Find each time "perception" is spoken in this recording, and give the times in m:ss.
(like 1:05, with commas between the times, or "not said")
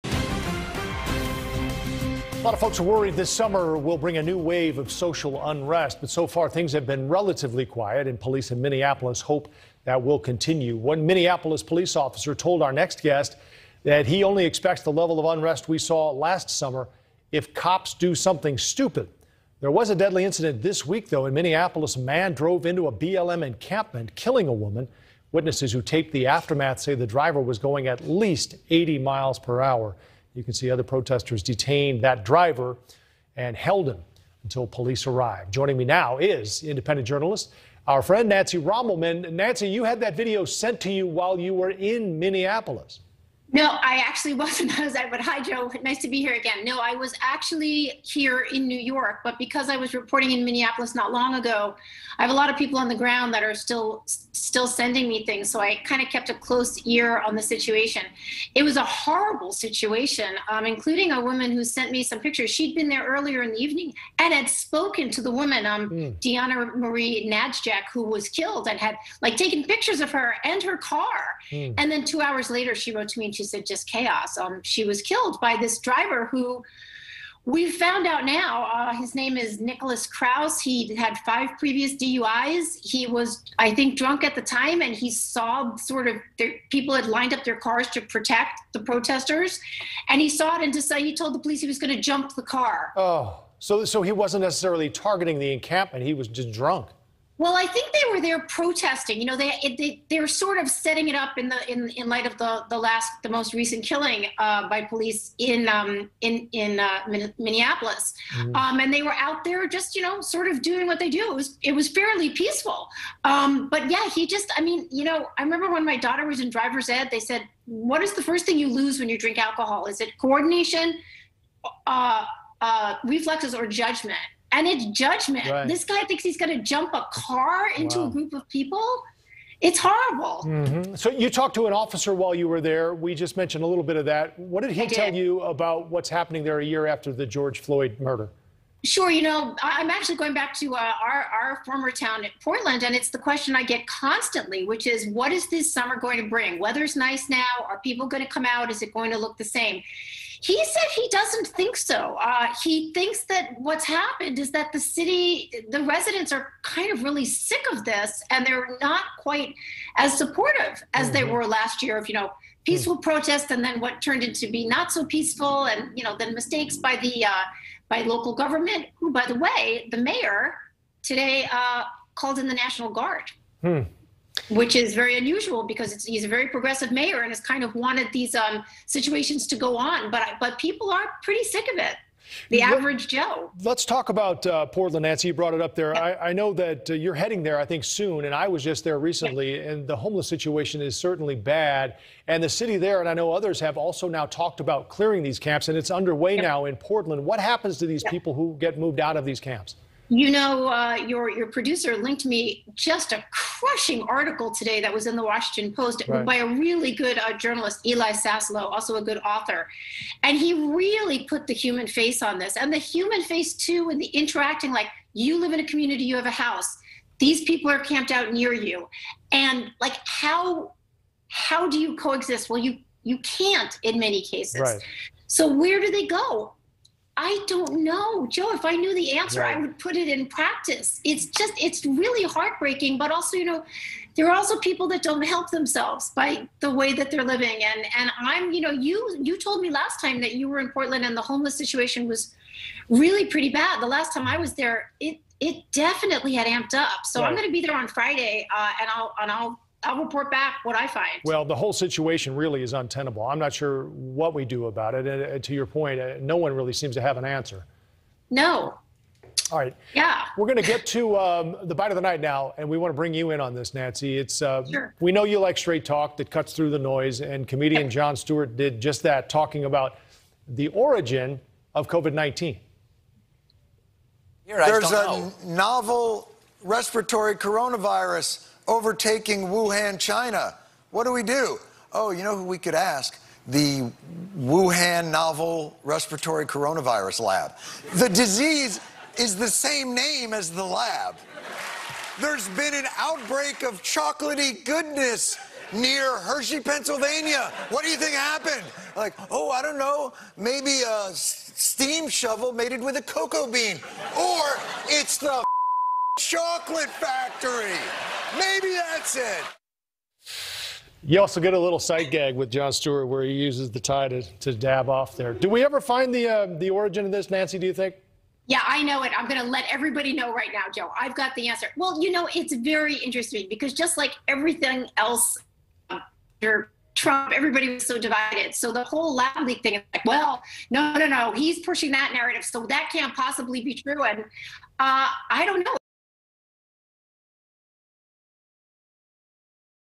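not said.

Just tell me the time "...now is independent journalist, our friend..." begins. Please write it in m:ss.
0:35.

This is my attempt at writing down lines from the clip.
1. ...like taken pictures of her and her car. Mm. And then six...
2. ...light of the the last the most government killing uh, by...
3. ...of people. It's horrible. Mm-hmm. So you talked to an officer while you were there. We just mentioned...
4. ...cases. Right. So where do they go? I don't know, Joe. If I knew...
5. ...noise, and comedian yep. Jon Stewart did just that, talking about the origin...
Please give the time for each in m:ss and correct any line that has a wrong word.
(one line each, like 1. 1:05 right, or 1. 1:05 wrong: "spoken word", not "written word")
1. 1:09 wrong: "two", not "six"
2. 1:42 wrong: "recent", not "government"
3. 2:08 right
4. 3:44 right
5. 4:26 right.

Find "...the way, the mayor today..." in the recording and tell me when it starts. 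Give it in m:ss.
2:49.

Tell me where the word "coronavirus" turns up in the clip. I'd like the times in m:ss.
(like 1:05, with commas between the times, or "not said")
4:37, 4:46.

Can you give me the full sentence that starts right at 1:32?
Oh, so so he wasn't necessarily targeting the encampment.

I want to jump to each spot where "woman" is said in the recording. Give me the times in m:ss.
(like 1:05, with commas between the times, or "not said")
0:24, 1:01, 1:05.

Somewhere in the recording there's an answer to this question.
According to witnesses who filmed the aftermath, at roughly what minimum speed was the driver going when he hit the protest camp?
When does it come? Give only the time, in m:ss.
0:28.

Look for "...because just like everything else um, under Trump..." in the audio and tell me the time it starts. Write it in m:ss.
5:23.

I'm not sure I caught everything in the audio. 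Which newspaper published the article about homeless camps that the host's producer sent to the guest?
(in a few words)
Washington Post.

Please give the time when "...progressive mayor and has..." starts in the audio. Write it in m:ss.
2:56.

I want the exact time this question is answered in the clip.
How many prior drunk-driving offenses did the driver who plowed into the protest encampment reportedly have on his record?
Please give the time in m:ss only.
1:21.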